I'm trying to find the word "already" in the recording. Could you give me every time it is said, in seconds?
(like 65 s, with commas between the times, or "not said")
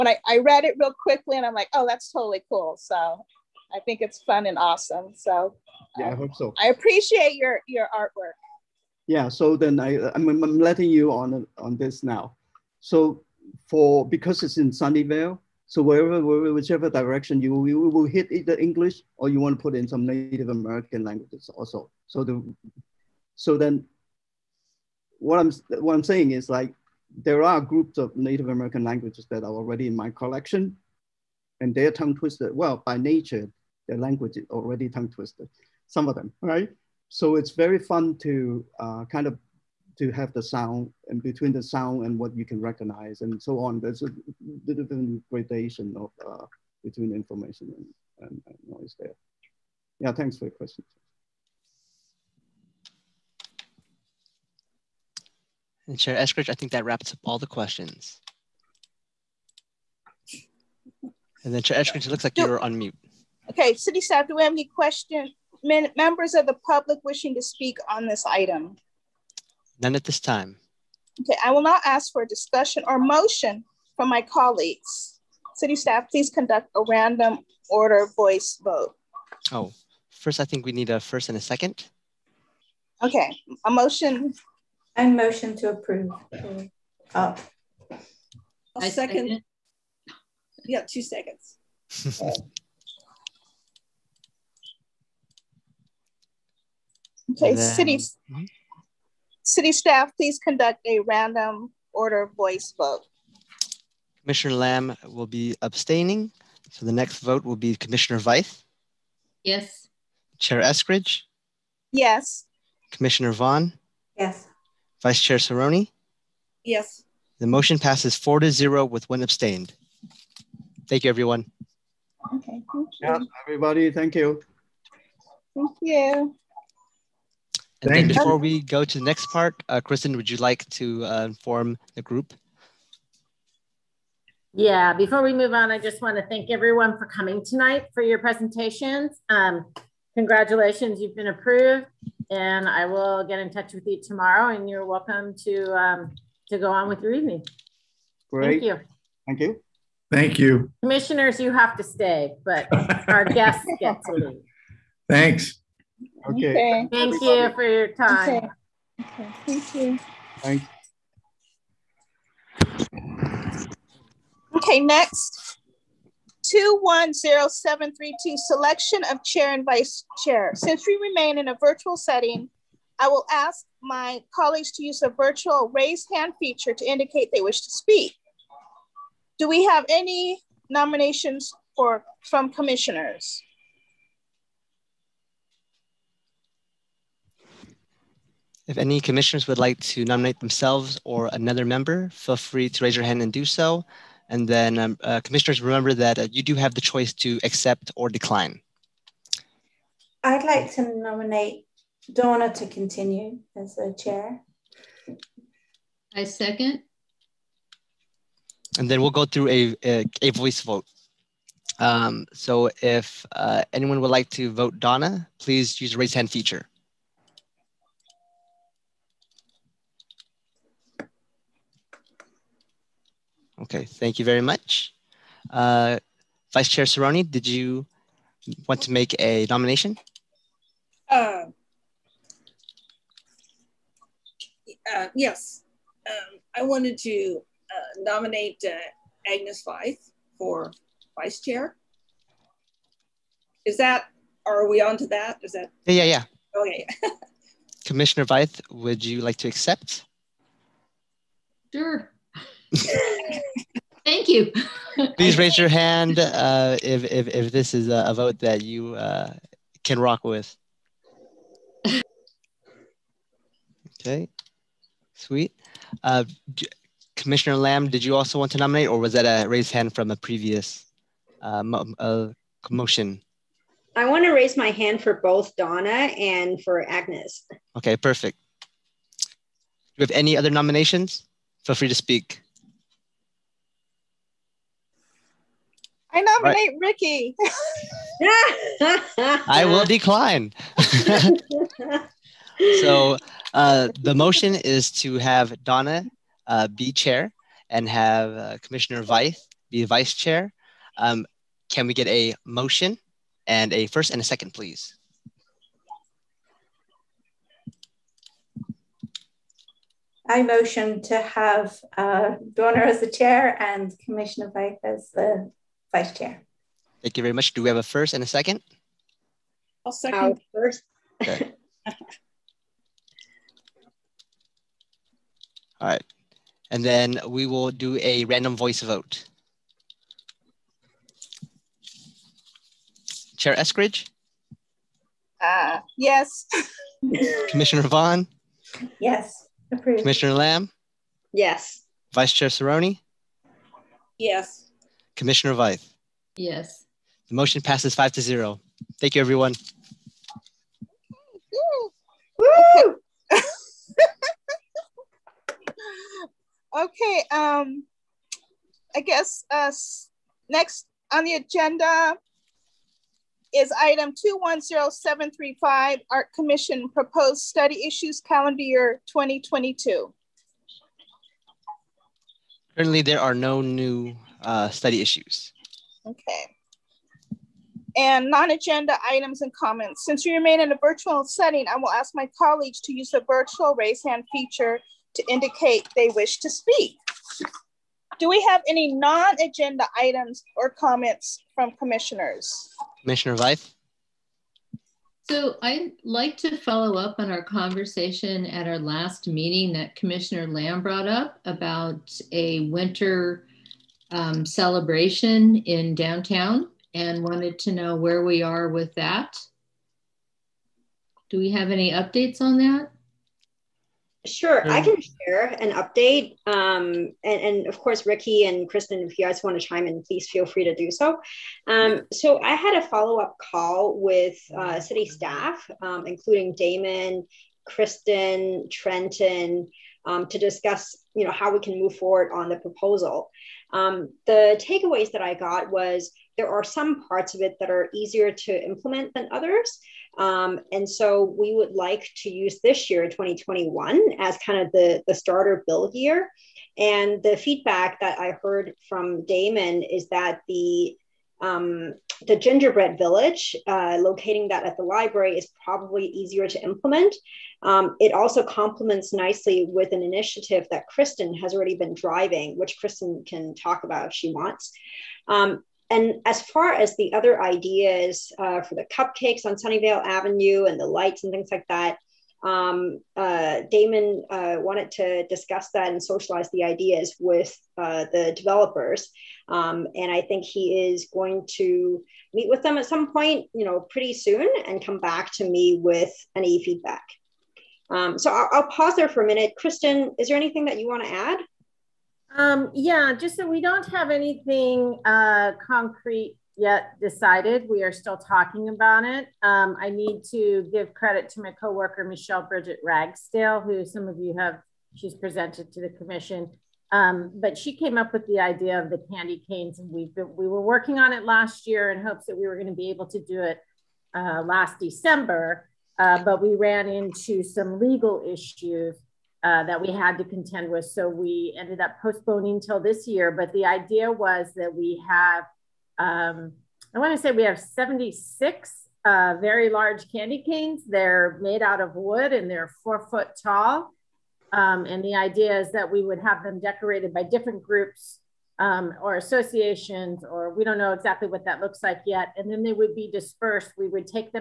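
29 s, 34 s, 461 s.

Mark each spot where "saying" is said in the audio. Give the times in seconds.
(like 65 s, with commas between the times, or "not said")
26 s.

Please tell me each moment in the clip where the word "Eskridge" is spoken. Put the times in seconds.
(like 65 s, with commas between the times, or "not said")
56 s, 61 s, 110 s, 333 s.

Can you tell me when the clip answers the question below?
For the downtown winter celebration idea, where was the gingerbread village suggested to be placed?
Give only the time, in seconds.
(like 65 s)
454 s.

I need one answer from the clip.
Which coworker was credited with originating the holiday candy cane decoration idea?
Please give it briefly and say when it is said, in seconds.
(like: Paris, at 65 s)
Michelle Bridget Ragsdale, at 502 s.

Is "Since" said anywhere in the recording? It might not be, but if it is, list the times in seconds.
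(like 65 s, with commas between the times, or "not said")
170 s, 380 s.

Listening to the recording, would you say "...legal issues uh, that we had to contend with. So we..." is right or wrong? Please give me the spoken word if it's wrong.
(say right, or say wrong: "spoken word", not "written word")
right.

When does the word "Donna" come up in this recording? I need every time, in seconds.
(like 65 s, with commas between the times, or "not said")
202 s, 214 s, 275 s, 295 s, 312 s.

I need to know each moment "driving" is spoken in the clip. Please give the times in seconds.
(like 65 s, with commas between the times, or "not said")
461 s.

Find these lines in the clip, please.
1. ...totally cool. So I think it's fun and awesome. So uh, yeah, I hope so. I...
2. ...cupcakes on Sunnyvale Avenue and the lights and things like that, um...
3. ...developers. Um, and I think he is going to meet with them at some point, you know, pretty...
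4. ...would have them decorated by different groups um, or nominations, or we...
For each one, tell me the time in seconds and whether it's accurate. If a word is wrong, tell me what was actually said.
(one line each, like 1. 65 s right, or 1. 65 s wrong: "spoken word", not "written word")
1. 2 s right
2. 468 s right
3. 478 s right
4. 536 s wrong: "associations", not "nominations".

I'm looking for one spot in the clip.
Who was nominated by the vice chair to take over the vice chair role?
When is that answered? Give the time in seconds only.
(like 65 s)
239 s.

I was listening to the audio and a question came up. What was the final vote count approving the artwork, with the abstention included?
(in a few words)
4 to 0.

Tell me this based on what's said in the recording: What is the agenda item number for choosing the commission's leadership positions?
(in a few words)
210732.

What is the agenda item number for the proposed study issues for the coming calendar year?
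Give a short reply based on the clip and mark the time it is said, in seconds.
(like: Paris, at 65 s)
210735, at 364 s.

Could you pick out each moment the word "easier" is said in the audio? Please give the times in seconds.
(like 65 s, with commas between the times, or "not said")
437 s, 456 s.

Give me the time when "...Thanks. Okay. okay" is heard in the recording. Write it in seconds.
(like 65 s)
155 s.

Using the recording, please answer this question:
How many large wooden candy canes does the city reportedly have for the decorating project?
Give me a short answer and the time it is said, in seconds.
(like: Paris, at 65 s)
76, at 527 s.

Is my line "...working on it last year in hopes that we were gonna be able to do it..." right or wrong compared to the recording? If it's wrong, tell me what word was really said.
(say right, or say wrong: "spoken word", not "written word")
right.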